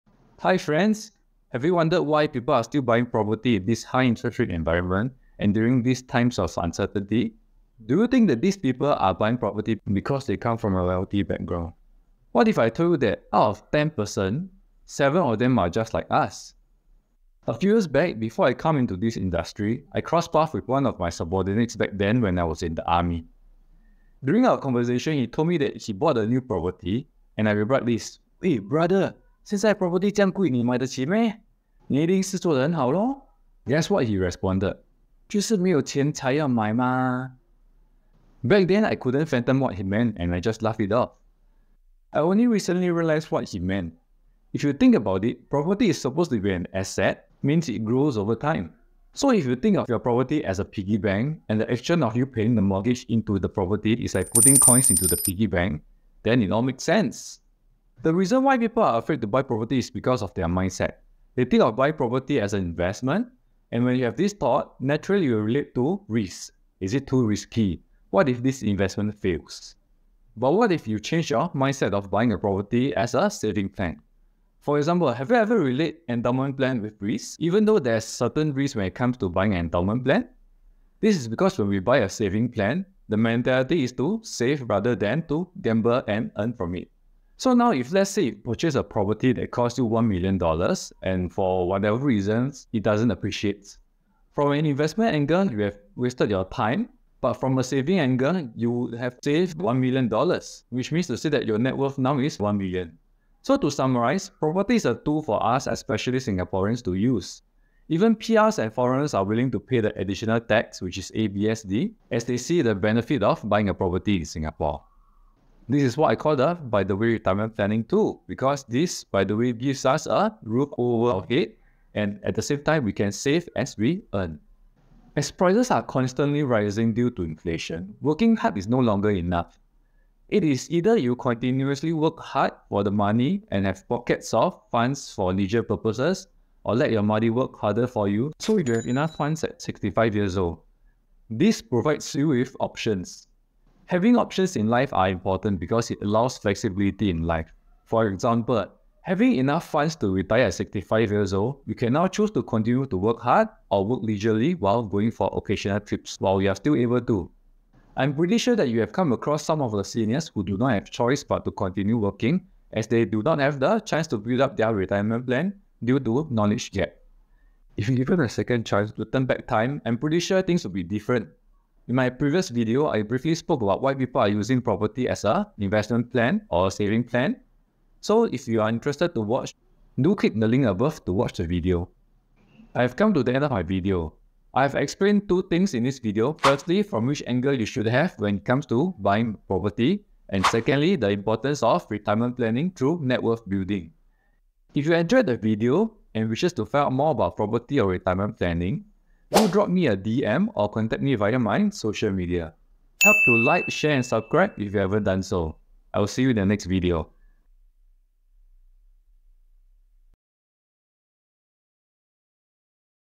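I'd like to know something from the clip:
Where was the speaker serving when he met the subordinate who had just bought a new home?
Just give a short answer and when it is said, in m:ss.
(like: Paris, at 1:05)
the army, at 0:22.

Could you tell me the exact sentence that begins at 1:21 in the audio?
This is because when we buy a saving plan, the mentality is to save rather than to gamble and earn from it.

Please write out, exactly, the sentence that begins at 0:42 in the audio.
I only recently realized what he meant.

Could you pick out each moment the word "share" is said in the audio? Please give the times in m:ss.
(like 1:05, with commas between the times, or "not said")
3:23.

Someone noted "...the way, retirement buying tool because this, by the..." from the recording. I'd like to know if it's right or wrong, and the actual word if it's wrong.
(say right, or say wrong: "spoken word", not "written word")
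wrong: "planning", not "buying".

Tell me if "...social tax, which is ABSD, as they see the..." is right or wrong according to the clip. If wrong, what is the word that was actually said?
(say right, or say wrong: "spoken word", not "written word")
wrong: "additional", not "social".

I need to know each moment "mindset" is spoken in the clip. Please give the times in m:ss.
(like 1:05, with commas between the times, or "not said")
1:00, 1:11.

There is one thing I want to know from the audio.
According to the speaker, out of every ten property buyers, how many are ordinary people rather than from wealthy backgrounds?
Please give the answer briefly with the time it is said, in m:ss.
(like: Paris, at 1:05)
7, at 0:14.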